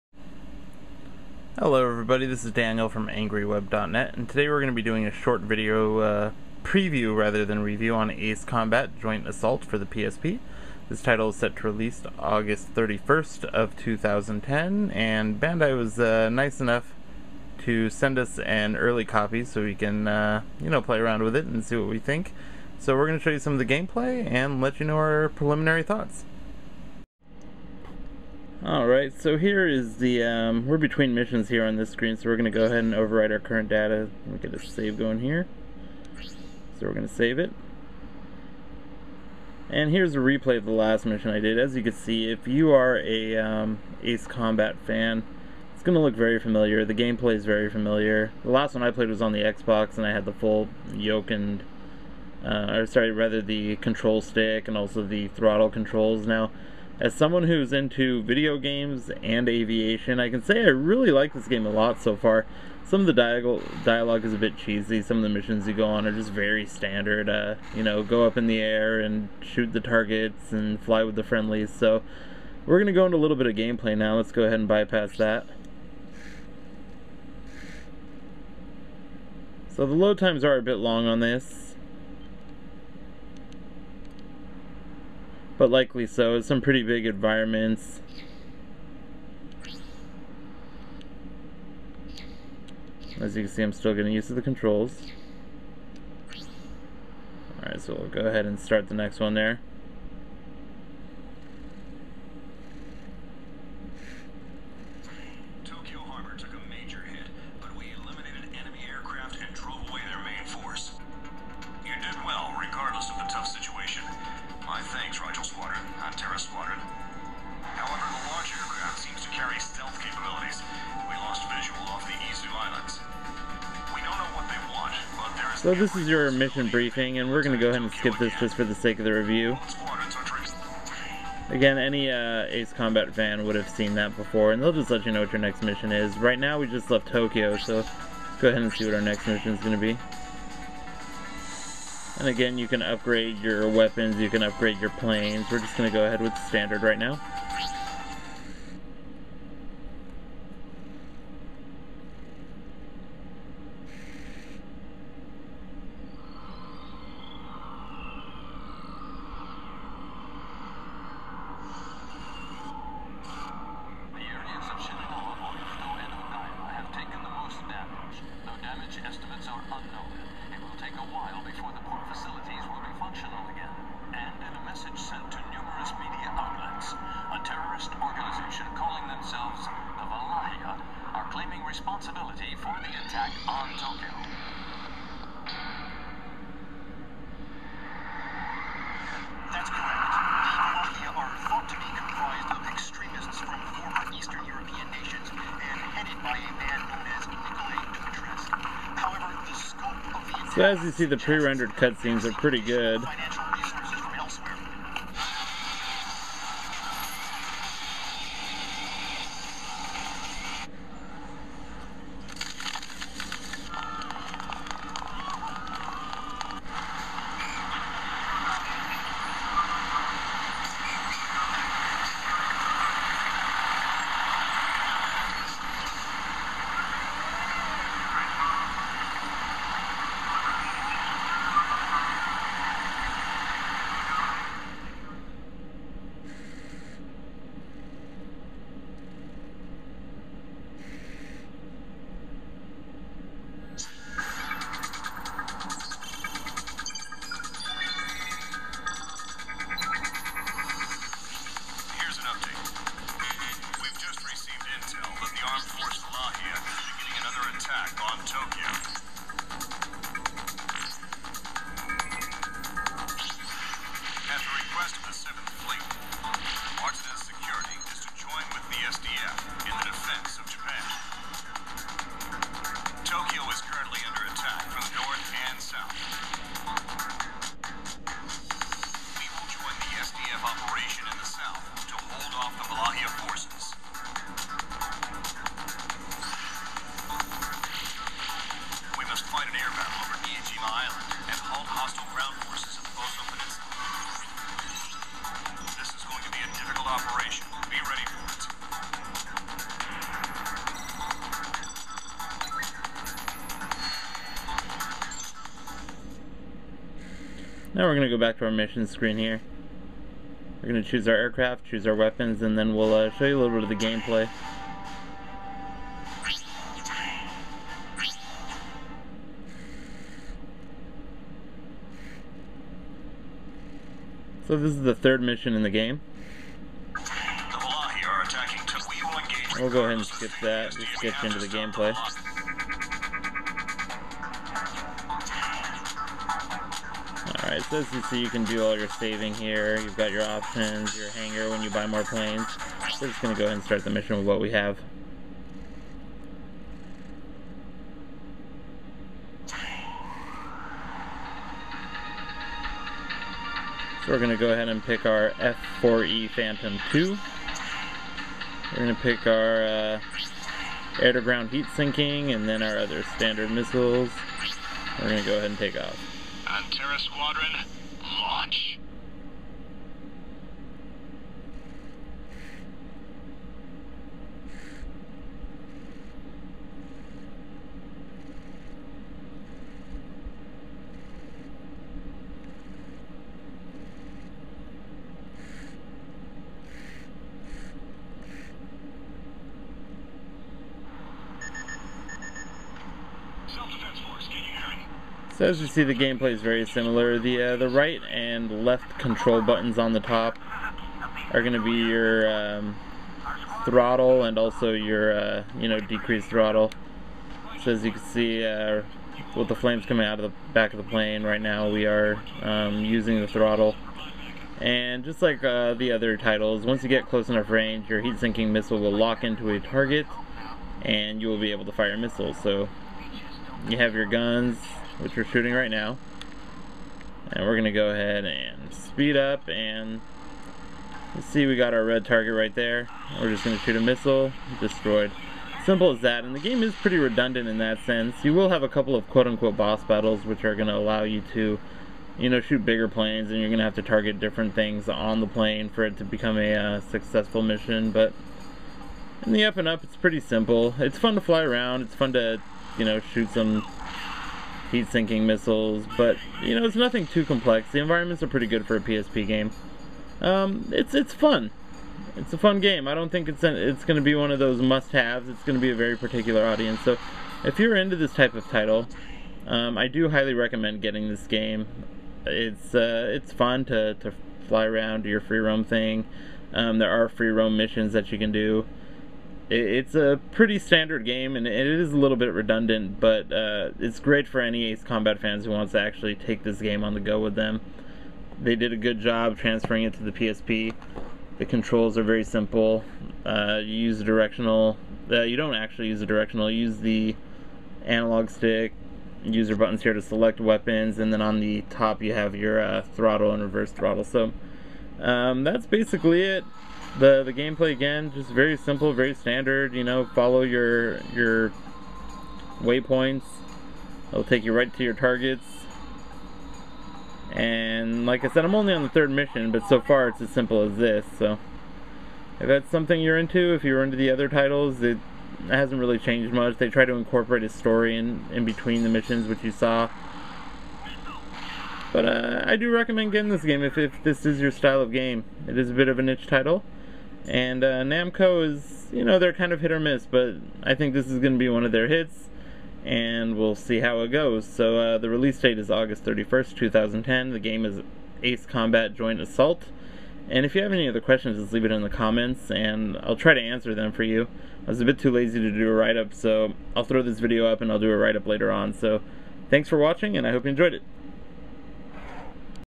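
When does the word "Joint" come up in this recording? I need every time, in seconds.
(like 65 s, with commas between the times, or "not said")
8 s, 548 s.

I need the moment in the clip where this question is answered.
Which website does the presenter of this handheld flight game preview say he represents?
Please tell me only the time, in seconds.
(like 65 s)
3 s.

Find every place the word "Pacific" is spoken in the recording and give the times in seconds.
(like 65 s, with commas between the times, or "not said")
not said.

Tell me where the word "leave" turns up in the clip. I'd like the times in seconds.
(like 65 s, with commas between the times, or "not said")
551 s.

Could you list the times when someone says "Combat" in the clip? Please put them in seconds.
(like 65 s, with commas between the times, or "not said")
8 s, 44 s, 132 s, 484 s, 548 s.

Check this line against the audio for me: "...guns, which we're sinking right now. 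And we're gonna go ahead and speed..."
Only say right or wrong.
wrong.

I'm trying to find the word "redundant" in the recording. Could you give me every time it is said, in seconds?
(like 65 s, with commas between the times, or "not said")
436 s, 482 s.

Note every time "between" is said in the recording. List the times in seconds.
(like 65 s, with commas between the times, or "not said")
30 s, 528 s.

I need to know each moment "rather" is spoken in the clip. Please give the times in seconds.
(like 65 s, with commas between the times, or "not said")
7 s, 53 s.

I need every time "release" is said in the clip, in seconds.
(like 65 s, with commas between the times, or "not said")
11 s, 545 s.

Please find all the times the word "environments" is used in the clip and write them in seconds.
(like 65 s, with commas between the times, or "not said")
87 s, 457 s.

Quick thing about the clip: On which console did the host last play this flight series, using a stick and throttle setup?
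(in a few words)
Xbox.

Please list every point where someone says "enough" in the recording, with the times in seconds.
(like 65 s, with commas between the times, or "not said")
16 s, 417 s.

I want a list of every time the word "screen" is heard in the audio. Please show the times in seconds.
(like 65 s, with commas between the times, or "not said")
31 s, 308 s.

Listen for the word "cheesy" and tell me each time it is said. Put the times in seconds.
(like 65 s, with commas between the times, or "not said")
64 s.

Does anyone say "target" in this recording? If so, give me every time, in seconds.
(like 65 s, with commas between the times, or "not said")
69 s, 419 s, 432 s, 443 s, 514 s.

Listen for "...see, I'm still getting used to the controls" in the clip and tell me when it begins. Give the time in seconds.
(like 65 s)
93 s.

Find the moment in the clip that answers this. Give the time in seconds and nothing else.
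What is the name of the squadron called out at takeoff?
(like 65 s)
366 s.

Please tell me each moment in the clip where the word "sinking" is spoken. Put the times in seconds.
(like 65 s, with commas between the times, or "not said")
361 s, 418 s, 454 s.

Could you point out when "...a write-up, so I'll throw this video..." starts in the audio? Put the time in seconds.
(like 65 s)
555 s.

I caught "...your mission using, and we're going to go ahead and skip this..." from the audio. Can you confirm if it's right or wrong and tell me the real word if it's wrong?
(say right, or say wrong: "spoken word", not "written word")
wrong: "briefing", not "using".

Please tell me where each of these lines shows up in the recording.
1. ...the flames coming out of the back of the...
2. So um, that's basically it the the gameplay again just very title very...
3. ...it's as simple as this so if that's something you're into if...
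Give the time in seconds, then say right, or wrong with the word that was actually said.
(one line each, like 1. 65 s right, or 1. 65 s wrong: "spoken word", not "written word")
1. 409 s right
2. 504 s wrong: "simple", not "title"
3. 520 s right.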